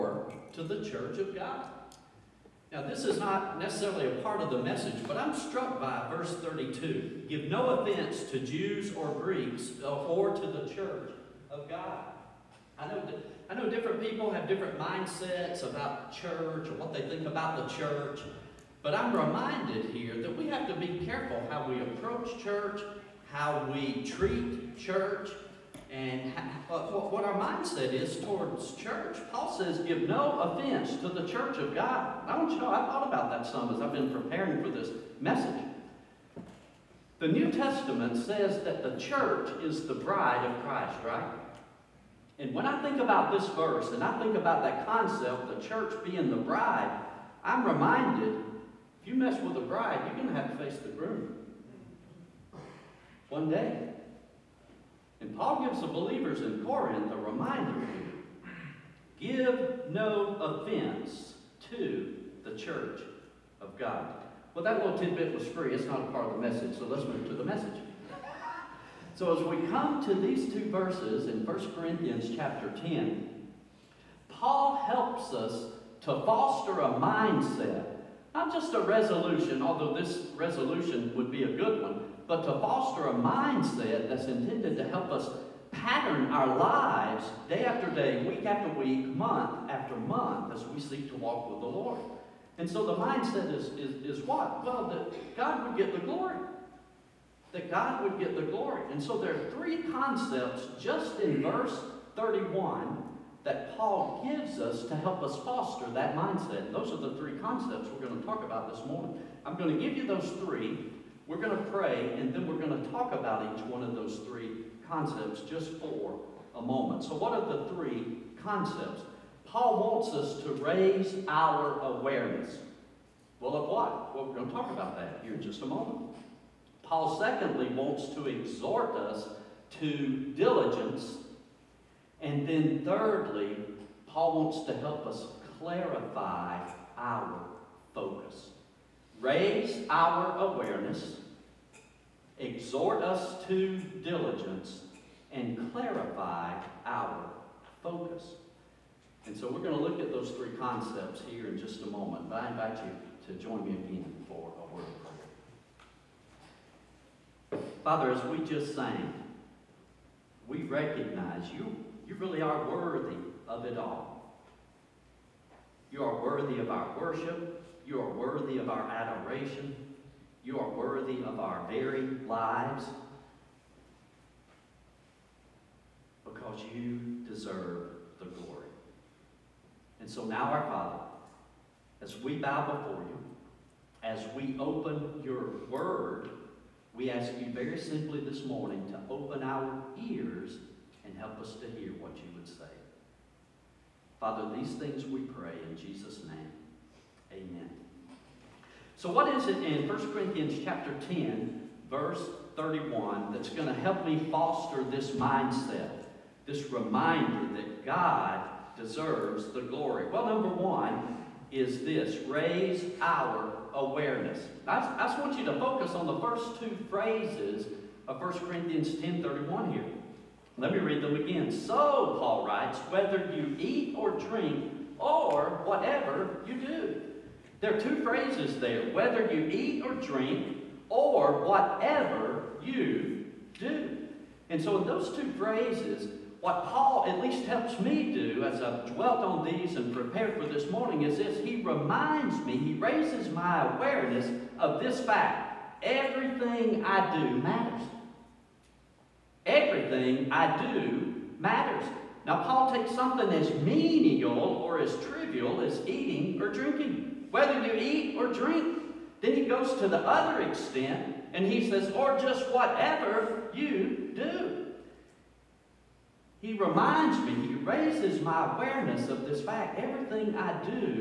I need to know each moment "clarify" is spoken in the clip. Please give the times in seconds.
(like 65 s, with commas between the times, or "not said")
135 s, 145 s.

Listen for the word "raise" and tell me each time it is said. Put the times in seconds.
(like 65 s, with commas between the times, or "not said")
120 s, 139 s, 212 s, 242 s, 267 s.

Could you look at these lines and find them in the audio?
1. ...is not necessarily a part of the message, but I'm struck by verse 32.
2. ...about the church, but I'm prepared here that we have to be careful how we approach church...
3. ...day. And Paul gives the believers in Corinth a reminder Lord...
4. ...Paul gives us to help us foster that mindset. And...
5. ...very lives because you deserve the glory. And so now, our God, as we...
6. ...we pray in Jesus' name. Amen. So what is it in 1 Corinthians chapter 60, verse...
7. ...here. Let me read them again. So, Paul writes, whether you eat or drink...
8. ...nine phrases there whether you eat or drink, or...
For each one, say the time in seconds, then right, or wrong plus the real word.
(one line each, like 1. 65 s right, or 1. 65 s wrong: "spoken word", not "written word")
1. 3 s right
2. 17 s wrong: "reminded", not "prepared"
3. 53 s wrong: "Give", not "Lord"
4. 103 s right
5. 171 s wrong: "Father", not "God"
6. 195 s wrong: "10", not "60"
7. 219 s right
8. 227 s wrong: "two", not "nine".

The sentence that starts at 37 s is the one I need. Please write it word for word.
The New Testament says that the church is the bride of Christ, right?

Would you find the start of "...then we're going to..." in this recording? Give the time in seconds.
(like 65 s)
112 s.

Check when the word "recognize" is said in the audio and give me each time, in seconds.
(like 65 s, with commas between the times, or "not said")
160 s.